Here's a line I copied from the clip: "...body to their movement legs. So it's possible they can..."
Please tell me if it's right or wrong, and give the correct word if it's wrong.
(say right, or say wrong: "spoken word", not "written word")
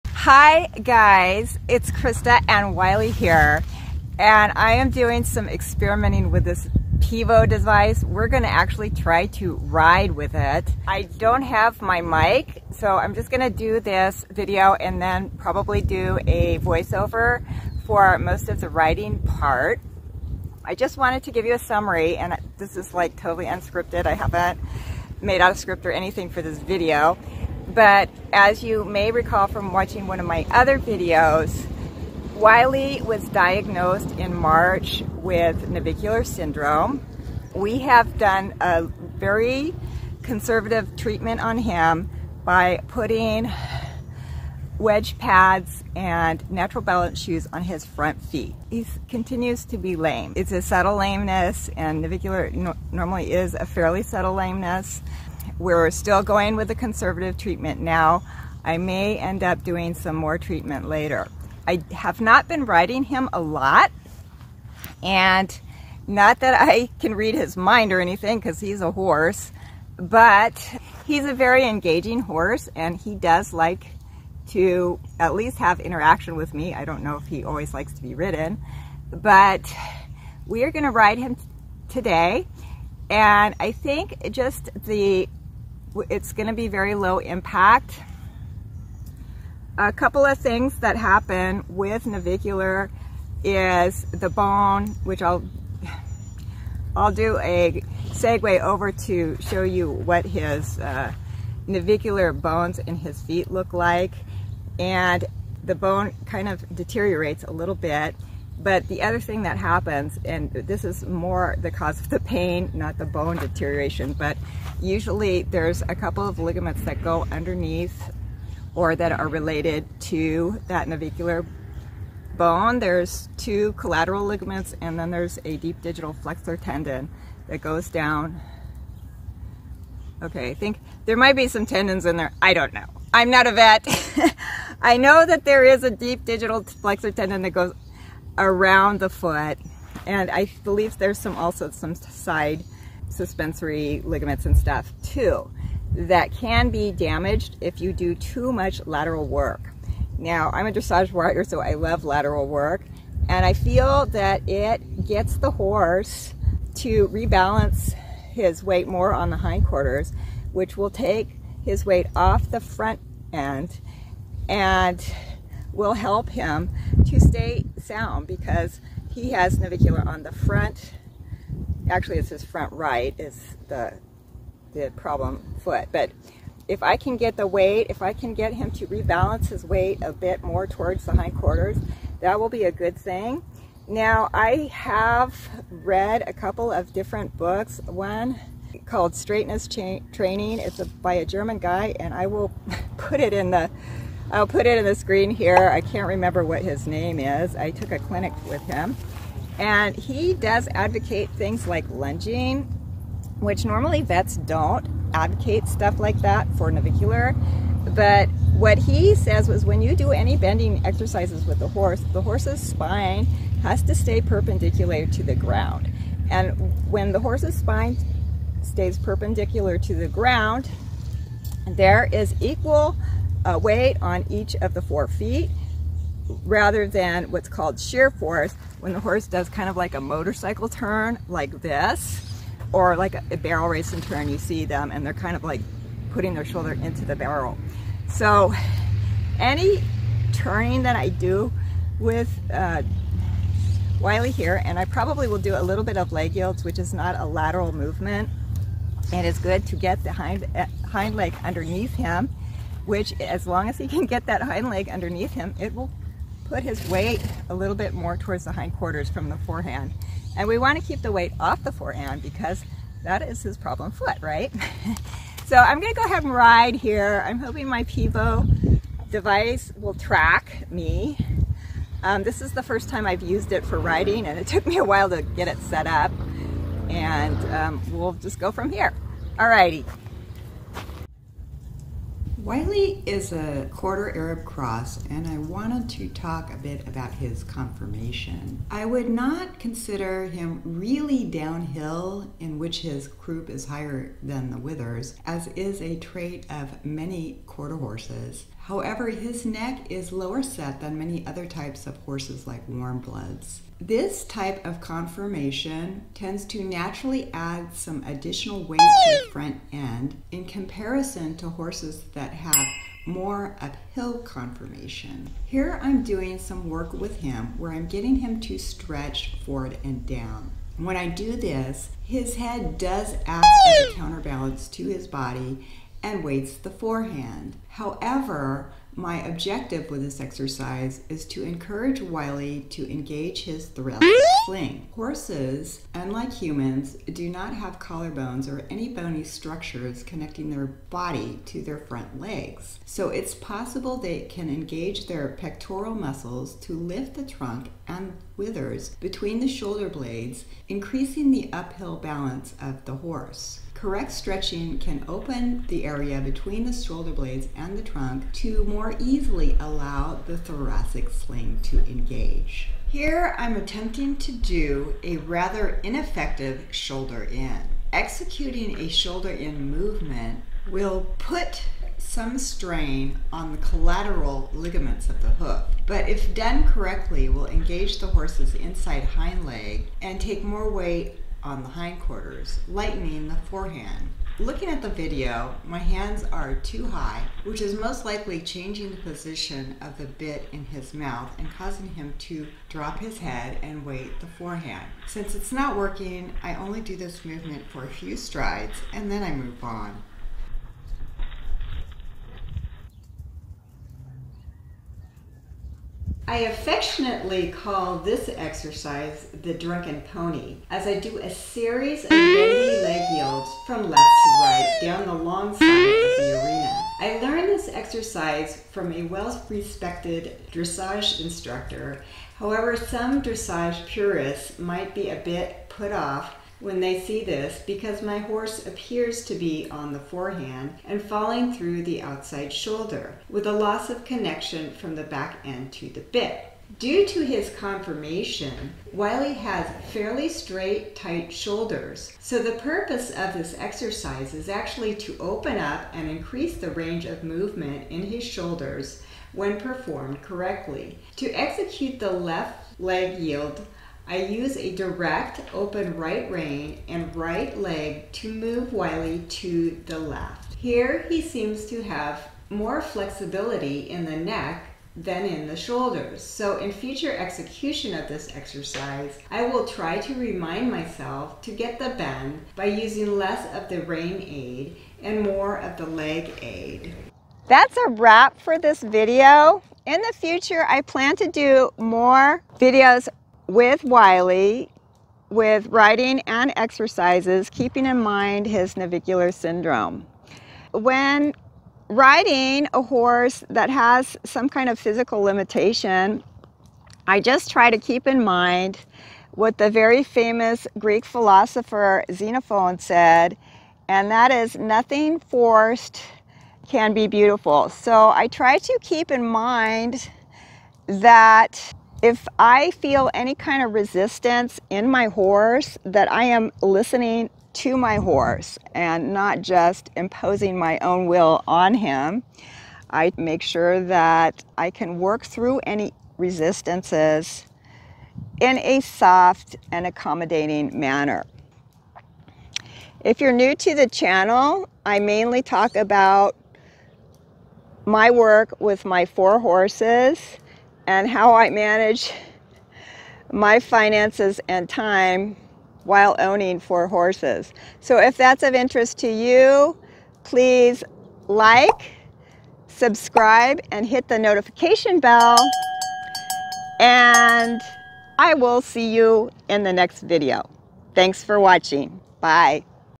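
wrong: "front", not "movement".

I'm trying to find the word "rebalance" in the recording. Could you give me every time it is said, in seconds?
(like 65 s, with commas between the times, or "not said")
157 s, 178 s.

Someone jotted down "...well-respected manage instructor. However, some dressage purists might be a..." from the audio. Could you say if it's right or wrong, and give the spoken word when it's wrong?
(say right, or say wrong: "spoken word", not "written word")
wrong: "dressage", not "manage".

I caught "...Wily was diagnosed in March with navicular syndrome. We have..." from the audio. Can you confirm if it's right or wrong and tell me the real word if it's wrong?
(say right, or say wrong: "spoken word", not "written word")
right.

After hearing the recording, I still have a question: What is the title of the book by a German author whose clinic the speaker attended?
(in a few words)
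Straightness Training.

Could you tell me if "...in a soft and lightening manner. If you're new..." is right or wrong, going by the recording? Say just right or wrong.
wrong.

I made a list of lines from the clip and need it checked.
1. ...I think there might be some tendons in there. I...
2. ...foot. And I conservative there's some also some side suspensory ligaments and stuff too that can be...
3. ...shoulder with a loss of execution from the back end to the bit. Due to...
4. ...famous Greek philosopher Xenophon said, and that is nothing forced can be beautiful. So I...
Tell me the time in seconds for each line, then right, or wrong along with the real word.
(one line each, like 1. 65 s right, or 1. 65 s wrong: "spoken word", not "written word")
1. 130 s right
2. 139 s wrong: "believe", not "conservative"
3. 432 s wrong: "connection", not "execution"
4. 500 s right.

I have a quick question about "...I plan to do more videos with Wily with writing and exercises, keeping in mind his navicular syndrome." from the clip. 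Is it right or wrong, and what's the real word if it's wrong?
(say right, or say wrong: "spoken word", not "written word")
right.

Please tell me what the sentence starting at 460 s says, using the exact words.
Here he seems to have more flexibility in the neck than in the shoulders.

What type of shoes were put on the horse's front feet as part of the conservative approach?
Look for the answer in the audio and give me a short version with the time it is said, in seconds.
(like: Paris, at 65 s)
natural balance shoes, at 46 s.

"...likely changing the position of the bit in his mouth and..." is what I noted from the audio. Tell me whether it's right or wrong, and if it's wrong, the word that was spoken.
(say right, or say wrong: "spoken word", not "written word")
right.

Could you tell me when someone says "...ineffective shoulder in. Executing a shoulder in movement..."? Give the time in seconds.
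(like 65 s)
365 s.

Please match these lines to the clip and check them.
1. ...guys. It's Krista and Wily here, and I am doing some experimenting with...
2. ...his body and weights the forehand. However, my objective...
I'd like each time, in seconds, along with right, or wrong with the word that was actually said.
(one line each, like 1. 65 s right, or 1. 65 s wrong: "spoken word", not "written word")
1. 0 s right
2. 324 s right.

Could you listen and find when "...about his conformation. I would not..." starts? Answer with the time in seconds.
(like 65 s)
286 s.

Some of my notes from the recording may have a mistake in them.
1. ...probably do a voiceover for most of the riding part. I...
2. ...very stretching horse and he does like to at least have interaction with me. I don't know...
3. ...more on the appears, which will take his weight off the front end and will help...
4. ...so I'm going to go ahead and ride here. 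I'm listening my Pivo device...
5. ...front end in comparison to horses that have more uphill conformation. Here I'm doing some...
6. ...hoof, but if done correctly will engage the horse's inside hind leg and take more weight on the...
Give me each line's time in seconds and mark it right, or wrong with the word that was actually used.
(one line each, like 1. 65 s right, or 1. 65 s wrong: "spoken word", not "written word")
1. 15 s right
2. 71 s wrong: "engaging", not "stretching"
3. 158 s wrong: "hindquarters", not "appears"
4. 265 s wrong: "hoping", not "listening"
5. 309 s right
6. 375 s right.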